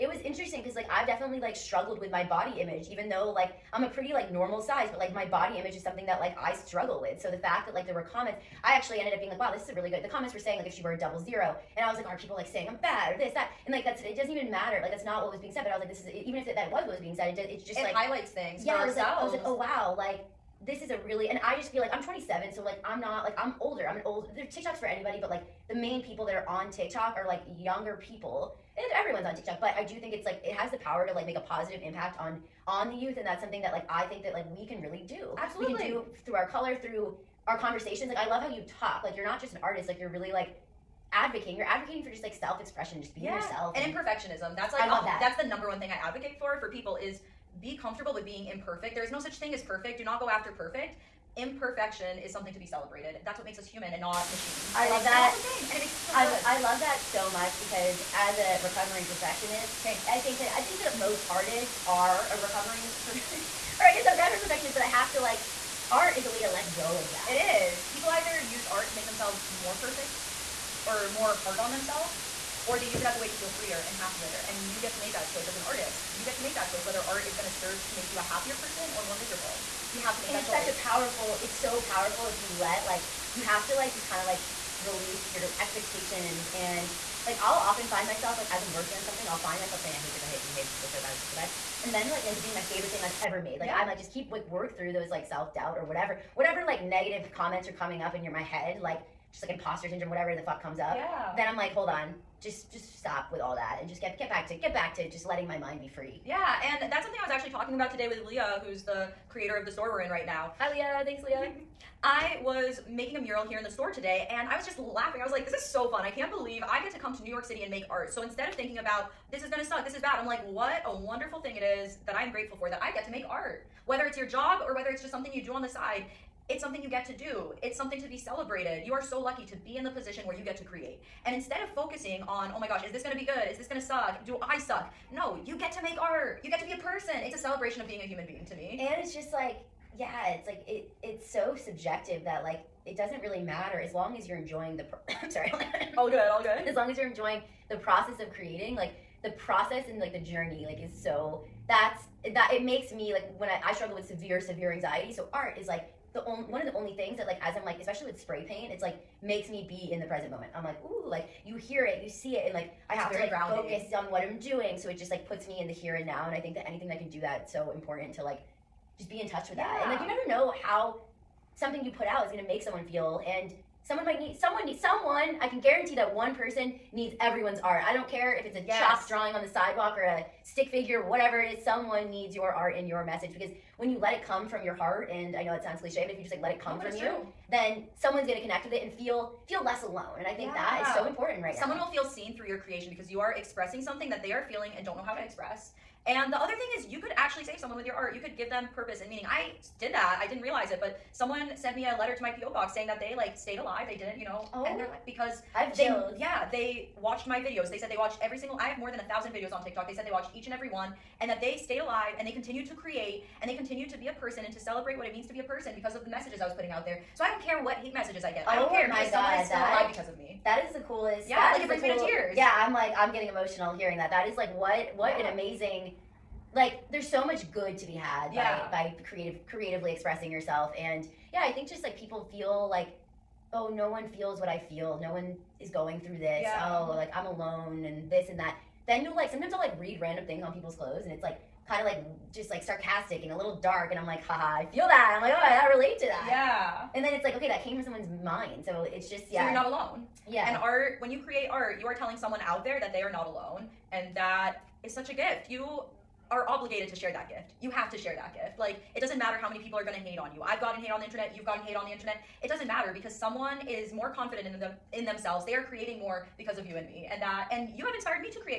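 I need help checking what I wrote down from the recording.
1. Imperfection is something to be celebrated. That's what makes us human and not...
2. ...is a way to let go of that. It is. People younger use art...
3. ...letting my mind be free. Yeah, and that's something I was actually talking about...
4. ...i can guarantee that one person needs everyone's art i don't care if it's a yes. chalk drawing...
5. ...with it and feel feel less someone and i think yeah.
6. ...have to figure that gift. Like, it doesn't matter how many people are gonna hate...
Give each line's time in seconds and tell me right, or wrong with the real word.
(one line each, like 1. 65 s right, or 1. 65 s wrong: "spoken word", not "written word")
1. 51 s right
2. 66 s wrong: "either", not "younger"
3. 105 s right
4. 175 s right
5. 188 s wrong: "alone", not "someone"
6. 257 s wrong: "share", not "figure".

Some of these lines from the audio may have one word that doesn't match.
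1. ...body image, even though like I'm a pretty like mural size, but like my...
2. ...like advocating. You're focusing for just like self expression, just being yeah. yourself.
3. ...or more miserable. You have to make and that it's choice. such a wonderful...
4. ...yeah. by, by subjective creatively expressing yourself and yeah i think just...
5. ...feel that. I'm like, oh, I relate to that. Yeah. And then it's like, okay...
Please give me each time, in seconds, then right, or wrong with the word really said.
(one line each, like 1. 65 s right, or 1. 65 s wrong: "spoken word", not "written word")
1. 2 s wrong: "normal", not "mural"
2. 40 s wrong: "advocating", not "focusing"
3. 78 s wrong: "powerful", not "wonderful"
4. 228 s wrong: "creative", not "subjective"
5. 244 s right.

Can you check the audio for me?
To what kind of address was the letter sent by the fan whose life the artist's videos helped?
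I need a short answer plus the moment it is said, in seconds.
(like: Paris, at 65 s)
PO box, at 202 s.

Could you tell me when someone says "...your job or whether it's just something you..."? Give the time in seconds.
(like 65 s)
124 s.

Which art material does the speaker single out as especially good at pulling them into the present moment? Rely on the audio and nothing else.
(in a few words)
Spray paint.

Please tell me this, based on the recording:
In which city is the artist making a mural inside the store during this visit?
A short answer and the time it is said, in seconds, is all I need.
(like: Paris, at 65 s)
New York City, at 117 s.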